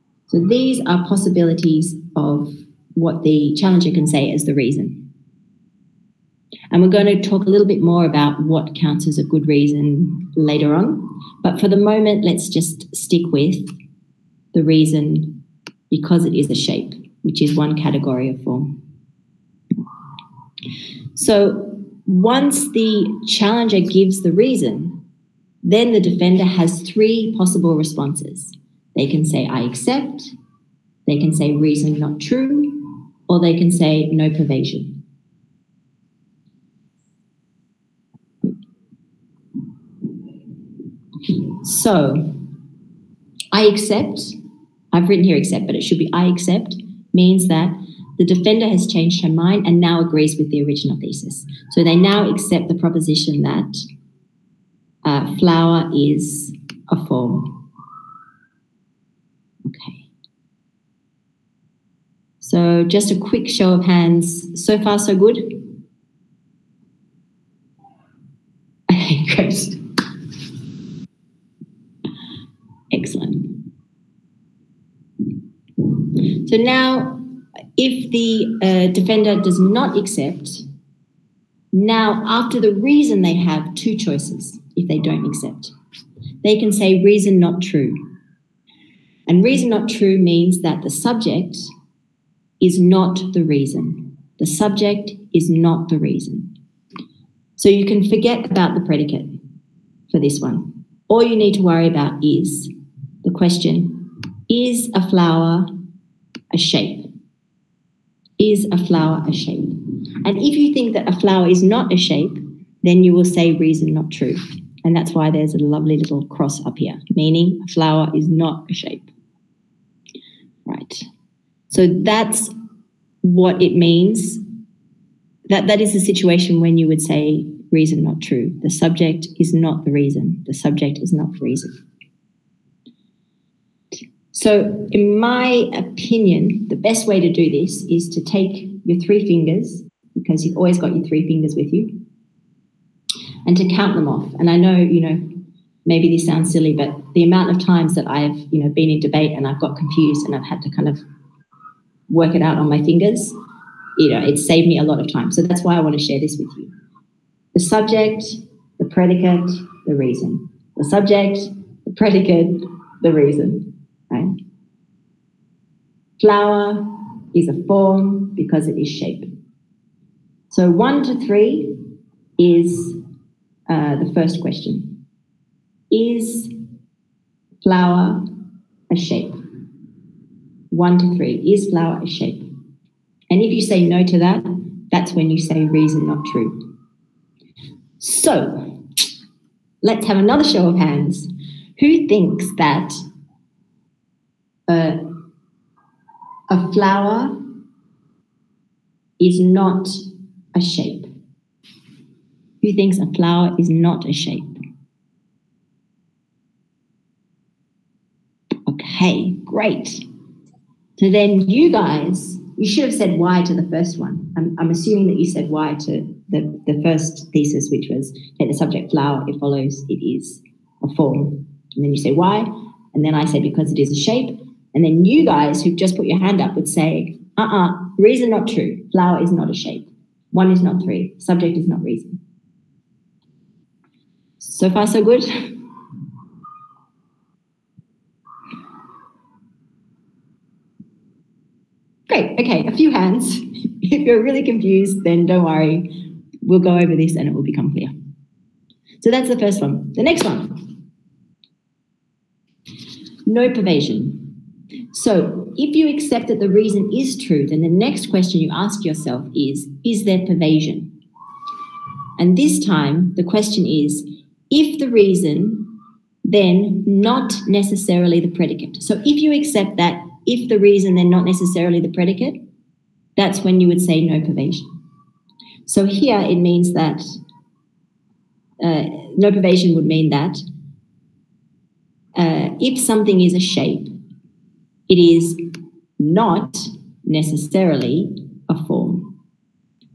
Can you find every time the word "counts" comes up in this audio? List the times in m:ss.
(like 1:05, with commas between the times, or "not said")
0:08, 2:23.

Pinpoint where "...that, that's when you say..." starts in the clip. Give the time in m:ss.
3:04.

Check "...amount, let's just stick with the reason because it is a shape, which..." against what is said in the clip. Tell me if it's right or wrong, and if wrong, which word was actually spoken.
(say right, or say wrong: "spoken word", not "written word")
wrong: "moment", not "amount".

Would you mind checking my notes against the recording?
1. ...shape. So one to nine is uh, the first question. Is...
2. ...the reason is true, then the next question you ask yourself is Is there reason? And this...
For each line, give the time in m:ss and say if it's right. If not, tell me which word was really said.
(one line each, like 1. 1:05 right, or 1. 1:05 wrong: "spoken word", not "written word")
1. 2:48 wrong: "three", not "nine"
2. 4:16 wrong: "pervasion", not "reason".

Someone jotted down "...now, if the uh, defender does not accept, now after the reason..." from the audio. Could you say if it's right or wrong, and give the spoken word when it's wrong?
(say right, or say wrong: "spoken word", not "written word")
right.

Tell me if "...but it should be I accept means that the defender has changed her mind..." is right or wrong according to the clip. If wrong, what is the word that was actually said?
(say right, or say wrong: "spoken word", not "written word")
right.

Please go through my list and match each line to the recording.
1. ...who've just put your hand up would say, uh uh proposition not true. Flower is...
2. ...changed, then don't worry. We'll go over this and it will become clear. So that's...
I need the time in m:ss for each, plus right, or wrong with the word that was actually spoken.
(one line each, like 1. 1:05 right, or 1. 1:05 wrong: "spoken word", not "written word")
1. 3:45 wrong: "reason", not "proposition"
2. 4:04 wrong: "confused", not "changed".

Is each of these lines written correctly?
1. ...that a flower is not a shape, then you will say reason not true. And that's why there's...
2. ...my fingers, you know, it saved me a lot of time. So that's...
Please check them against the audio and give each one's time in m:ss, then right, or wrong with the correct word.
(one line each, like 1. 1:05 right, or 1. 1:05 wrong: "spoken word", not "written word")
1. 1:50 right
2. 2:32 right.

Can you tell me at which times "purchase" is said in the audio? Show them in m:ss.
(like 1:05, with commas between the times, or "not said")
not said.